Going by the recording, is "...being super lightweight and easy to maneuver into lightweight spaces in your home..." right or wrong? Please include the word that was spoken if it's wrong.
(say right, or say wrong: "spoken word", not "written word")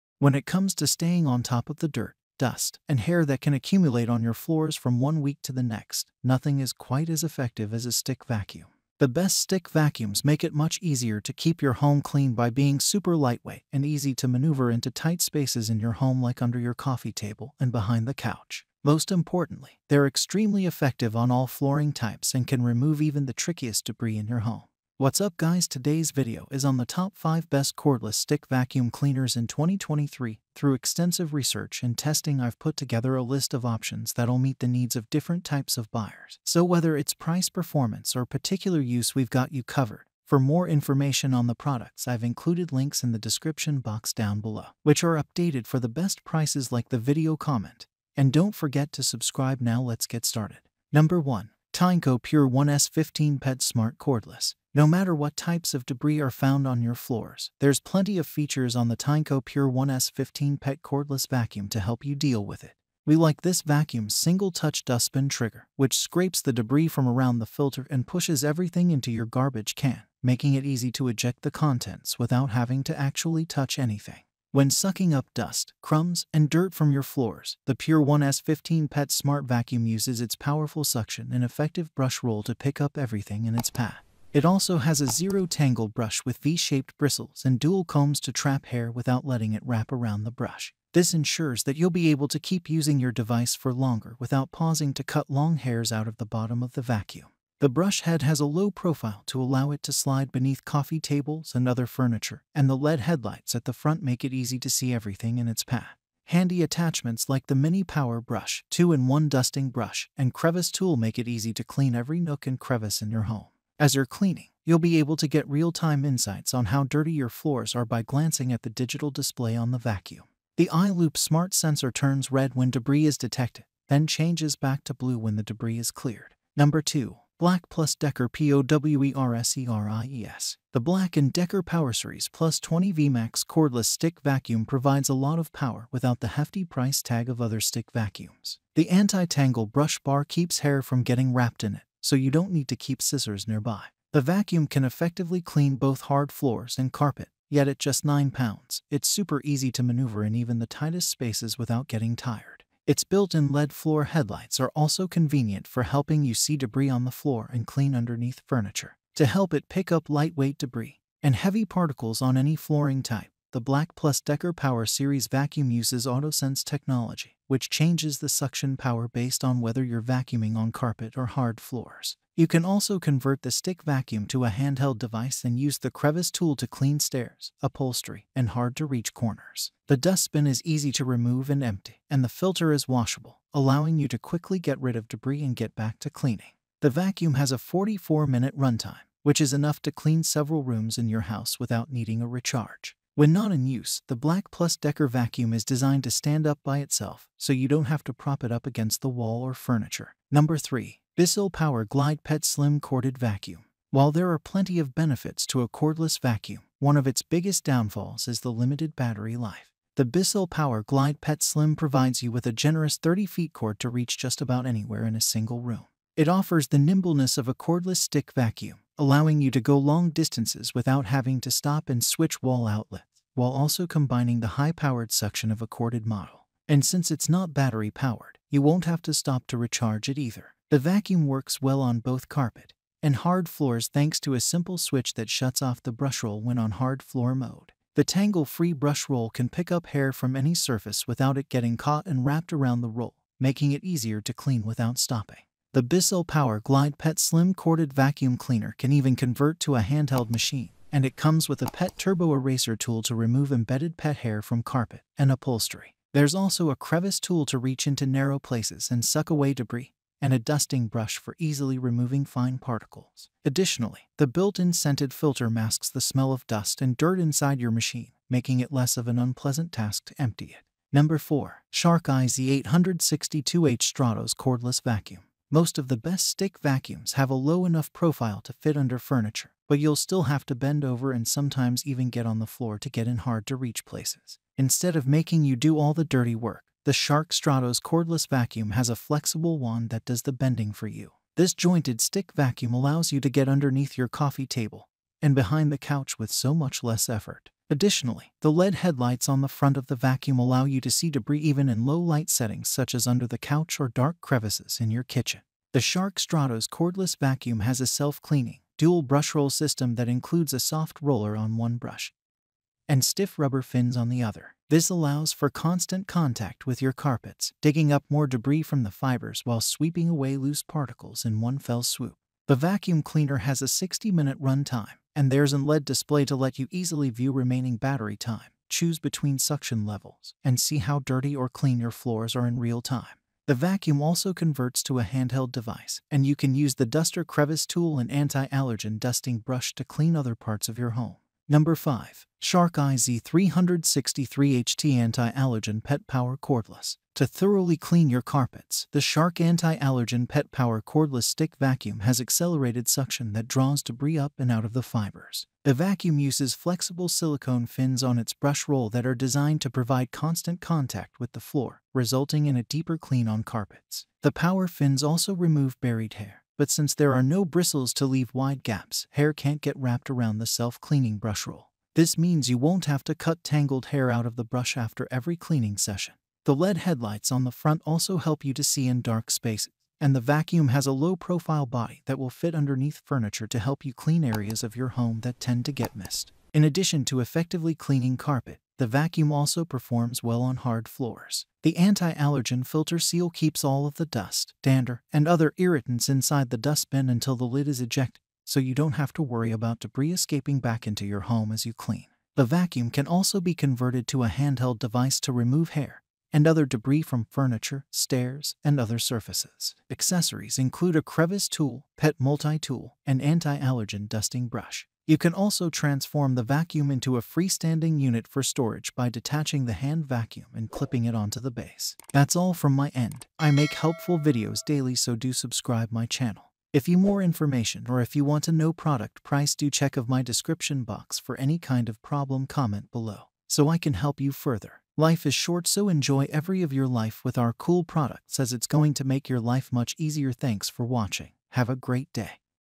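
wrong: "tight", not "lightweight".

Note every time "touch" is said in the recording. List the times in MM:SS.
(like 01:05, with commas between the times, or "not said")
01:04, 01:13.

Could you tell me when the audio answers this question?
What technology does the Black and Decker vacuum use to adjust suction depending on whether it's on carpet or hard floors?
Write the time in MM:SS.
02:46.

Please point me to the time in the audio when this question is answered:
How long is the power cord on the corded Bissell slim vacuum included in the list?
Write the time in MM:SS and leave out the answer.
03:32.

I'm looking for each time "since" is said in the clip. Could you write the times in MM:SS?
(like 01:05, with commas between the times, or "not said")
03:46, 06:06.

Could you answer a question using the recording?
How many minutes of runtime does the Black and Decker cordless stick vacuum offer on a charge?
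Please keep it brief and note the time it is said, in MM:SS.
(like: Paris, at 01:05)
44 minutes, at 03:07.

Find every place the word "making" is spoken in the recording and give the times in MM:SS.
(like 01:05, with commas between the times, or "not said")
01:10, 04:03, 04:28, 04:45.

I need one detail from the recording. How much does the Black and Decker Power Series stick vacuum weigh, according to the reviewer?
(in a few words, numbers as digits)
9 pounds.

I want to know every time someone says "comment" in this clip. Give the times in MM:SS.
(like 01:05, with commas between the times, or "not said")
00:47, 07:12.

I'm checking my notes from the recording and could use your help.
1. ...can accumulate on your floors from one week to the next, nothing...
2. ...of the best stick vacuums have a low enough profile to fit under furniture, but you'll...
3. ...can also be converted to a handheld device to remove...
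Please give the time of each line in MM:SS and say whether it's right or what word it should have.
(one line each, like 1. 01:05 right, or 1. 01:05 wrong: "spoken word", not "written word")
1. 00:03 right
2. 04:35 right
3. 06:42 right.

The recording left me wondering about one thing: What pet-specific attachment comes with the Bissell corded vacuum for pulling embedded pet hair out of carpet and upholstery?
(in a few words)
pet turbo eraser tool.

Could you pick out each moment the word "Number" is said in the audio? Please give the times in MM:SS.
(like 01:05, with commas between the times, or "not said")
00:50, 02:06, 03:20, 04:30, 05:41.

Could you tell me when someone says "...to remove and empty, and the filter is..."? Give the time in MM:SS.
03:00.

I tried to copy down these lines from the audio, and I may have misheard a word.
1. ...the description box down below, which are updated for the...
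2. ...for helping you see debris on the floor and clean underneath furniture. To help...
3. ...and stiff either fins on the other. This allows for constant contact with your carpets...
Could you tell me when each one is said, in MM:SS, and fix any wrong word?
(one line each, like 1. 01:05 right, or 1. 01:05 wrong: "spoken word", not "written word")
1. 00:43 right
2. 02:35 right
3. 05:12 wrong: "rubber", not "either".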